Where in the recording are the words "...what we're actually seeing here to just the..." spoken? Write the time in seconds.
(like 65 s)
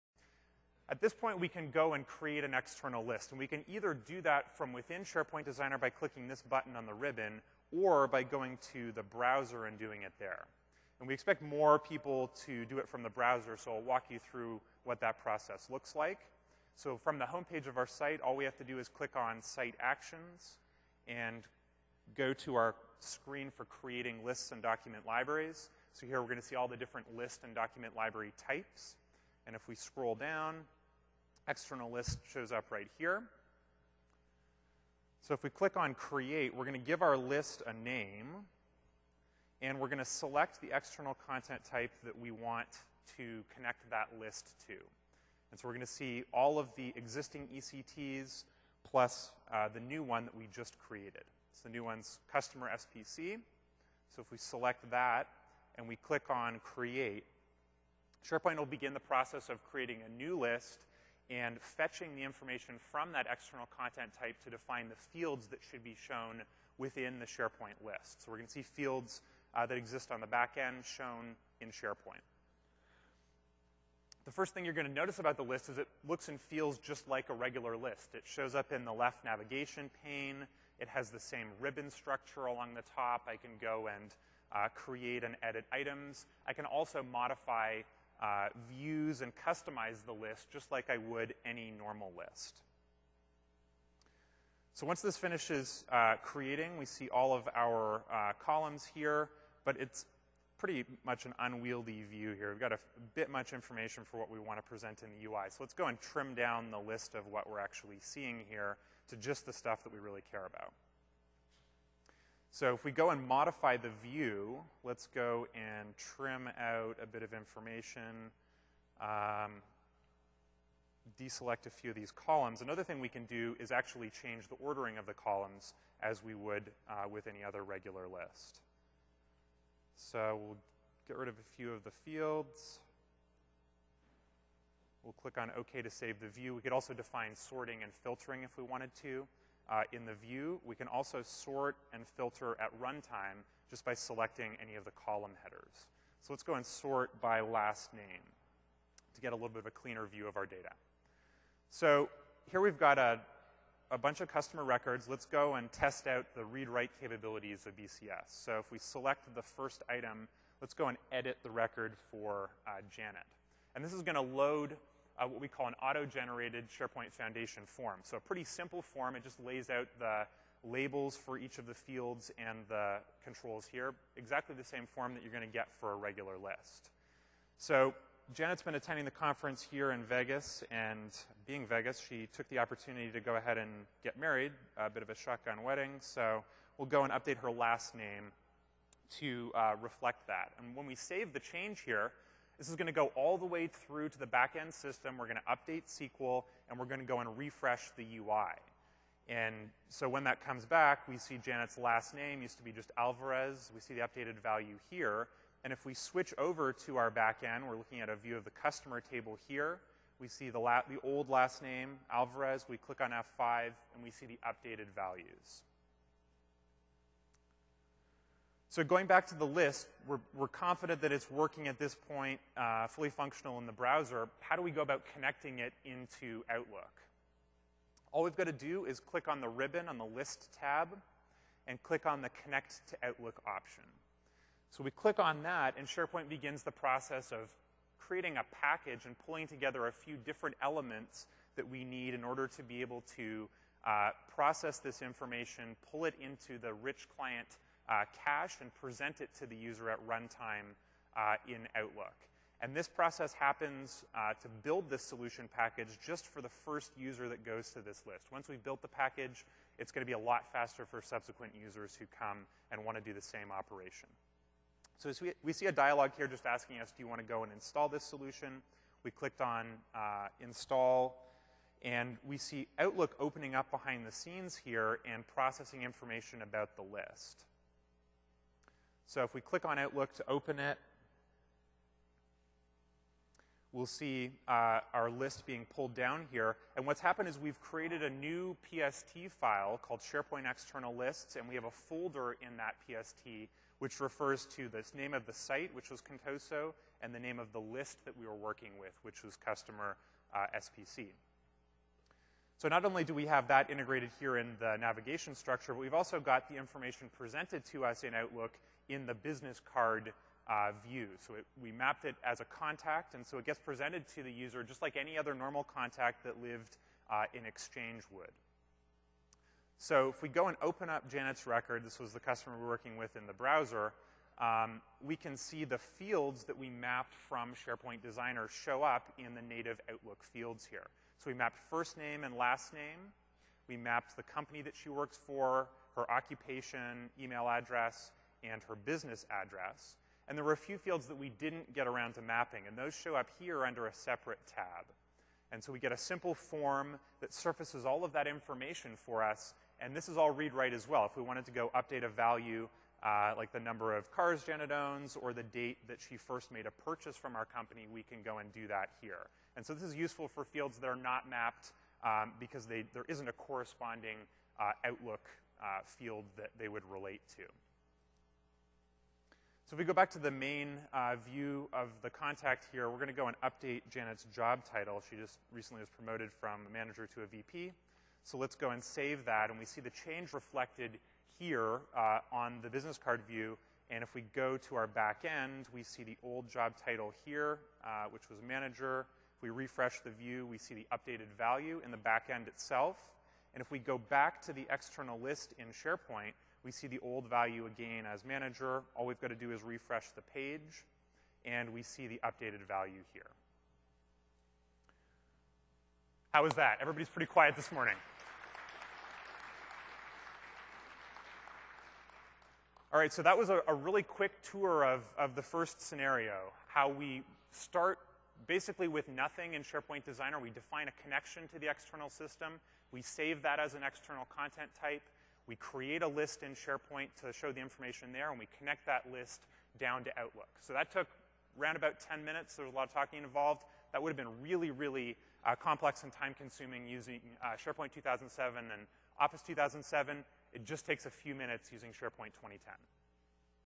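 107 s.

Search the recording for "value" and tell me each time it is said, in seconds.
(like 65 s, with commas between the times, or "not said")
204 s, 214 s, 352 s, 391 s, 397 s, 402 s.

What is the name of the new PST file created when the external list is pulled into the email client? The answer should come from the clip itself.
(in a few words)
SharePoint External Lists.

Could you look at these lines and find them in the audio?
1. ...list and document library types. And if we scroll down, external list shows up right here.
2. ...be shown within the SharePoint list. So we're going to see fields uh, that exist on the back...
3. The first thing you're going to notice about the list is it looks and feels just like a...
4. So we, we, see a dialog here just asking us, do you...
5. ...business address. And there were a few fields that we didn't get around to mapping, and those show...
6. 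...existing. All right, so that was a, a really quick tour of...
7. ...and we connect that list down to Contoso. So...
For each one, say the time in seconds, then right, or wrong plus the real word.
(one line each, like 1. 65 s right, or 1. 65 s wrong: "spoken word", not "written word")
1. 27 s right
2. 65 s right
3. 74 s right
4. 264 s right
5. 338 s right
6. 407 s wrong: "morning", not "existing"
7. 428 s wrong: "Outlook", not "Contoso".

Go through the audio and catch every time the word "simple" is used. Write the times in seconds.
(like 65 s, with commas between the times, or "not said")
168 s, 345 s.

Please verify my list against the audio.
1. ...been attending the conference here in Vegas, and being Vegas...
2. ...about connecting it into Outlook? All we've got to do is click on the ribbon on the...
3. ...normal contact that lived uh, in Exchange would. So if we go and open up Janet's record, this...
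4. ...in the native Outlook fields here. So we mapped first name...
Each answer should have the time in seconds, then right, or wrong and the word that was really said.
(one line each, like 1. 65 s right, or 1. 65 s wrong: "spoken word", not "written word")
1. 178 s right
2. 224 s right
3. 315 s right
4. 329 s right.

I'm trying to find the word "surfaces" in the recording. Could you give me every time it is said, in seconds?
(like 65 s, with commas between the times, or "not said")
347 s.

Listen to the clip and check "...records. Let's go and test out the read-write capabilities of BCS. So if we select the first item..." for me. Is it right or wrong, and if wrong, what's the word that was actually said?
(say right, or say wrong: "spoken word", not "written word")
right.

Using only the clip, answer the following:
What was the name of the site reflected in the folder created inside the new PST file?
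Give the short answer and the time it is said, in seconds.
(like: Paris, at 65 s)
Contoso, at 296 s.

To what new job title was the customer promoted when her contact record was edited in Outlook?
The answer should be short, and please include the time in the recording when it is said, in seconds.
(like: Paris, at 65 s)
VP, at 377 s.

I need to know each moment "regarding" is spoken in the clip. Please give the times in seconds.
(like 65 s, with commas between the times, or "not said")
not said.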